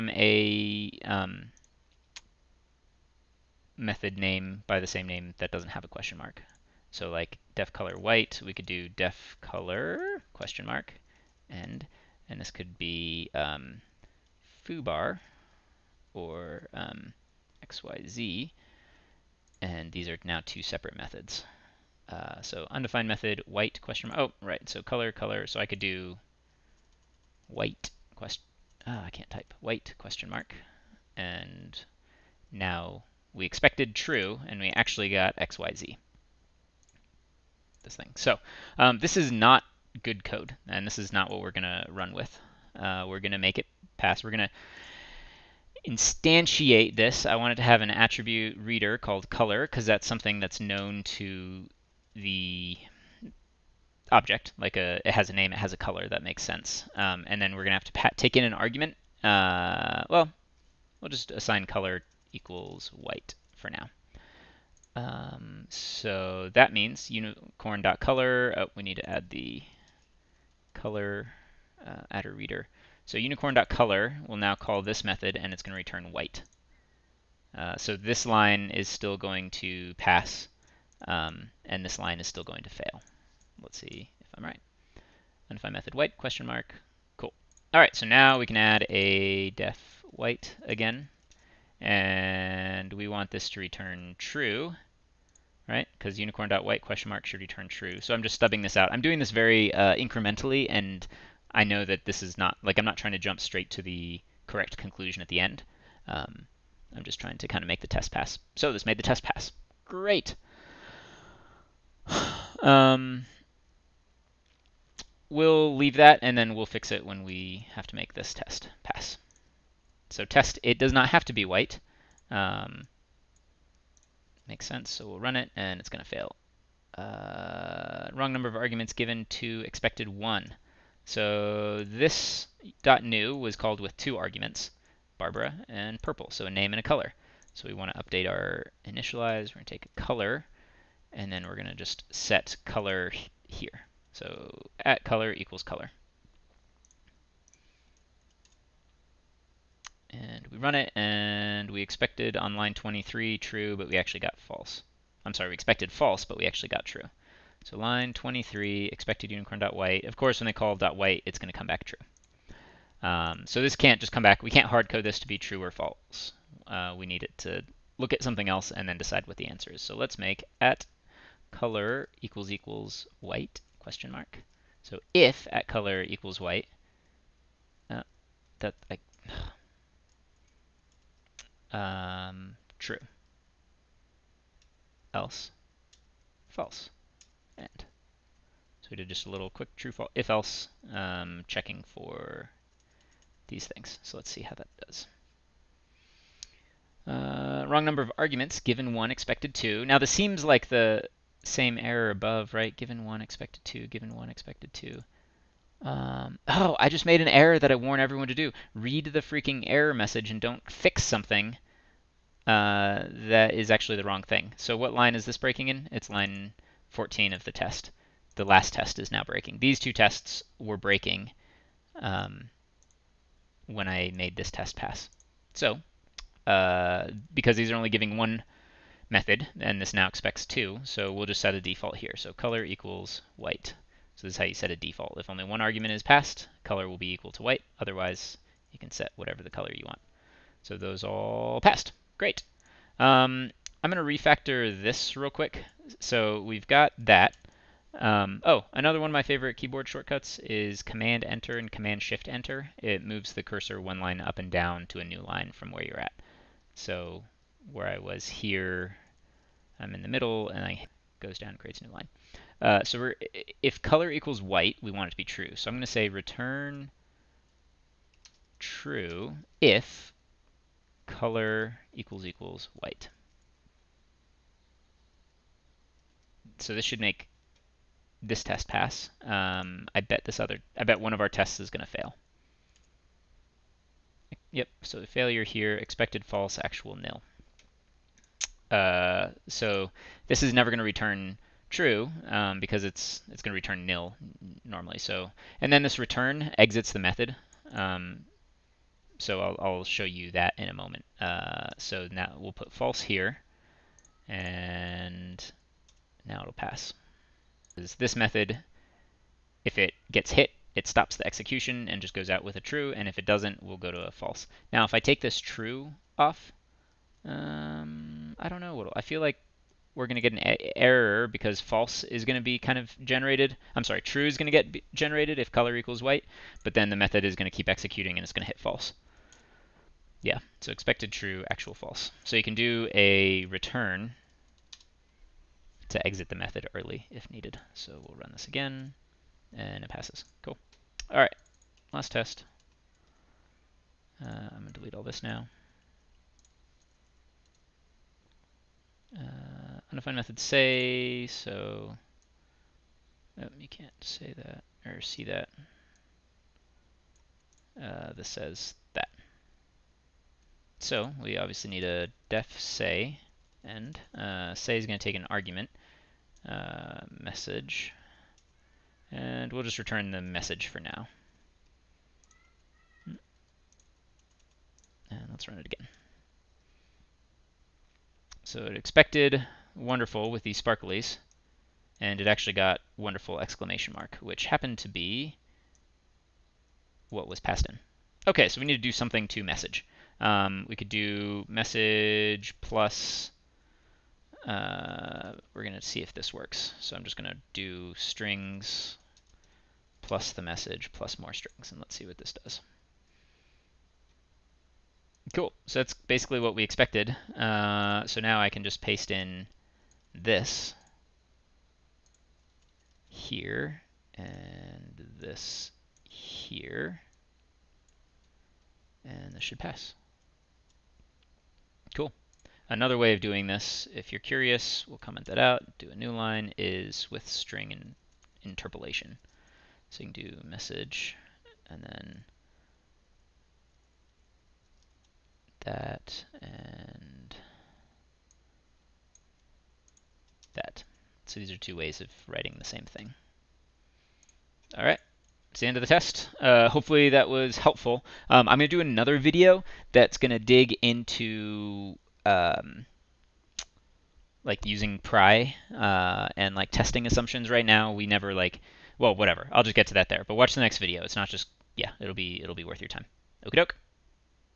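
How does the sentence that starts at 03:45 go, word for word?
So, uh, because these are only giving one method, and this now expects 2, so we'll just set a default here.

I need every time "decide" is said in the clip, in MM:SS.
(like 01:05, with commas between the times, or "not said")
02:48.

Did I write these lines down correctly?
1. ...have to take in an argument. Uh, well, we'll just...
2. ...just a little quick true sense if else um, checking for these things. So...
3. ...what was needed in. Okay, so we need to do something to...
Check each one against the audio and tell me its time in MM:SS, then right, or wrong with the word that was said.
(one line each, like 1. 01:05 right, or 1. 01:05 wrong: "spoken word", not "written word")
1. 00:57 right
2. 03:09 wrong: "false", not "sense"
3. 06:27 wrong: "passed", not "needed".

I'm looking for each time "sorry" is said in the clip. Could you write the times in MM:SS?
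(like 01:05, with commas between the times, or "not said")
02:35, 05:23.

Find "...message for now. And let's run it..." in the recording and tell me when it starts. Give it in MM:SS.
06:10.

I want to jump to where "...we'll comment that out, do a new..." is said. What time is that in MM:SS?
07:04.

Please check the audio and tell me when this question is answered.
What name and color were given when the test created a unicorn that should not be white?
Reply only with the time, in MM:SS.
02:15.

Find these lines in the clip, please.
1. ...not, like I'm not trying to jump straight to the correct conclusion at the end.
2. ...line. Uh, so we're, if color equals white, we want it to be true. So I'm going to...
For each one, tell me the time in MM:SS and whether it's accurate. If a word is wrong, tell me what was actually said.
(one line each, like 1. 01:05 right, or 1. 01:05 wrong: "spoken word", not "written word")
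1. 01:42 right
2. 04:21 right.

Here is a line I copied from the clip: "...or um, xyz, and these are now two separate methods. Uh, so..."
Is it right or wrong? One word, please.
right.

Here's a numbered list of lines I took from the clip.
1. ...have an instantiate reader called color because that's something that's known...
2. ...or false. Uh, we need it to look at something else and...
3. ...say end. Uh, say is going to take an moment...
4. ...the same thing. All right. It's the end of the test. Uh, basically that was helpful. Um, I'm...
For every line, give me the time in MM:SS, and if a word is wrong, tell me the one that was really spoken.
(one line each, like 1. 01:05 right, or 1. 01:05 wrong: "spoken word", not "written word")
1. 00:47 wrong: "attribute", not "instantiate"
2. 02:45 right
3. 06:02 wrong: "argument", not "moment"
4. 07:22 wrong: "hopefully", not "basically".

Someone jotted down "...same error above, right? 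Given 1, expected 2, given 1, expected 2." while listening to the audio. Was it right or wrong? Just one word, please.
right.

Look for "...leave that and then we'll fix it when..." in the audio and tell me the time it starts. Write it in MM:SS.
01:55.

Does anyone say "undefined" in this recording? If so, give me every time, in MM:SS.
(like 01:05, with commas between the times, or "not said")
00:22, 01:25.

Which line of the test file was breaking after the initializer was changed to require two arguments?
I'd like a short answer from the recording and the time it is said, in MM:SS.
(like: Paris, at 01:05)
14, at 03:36.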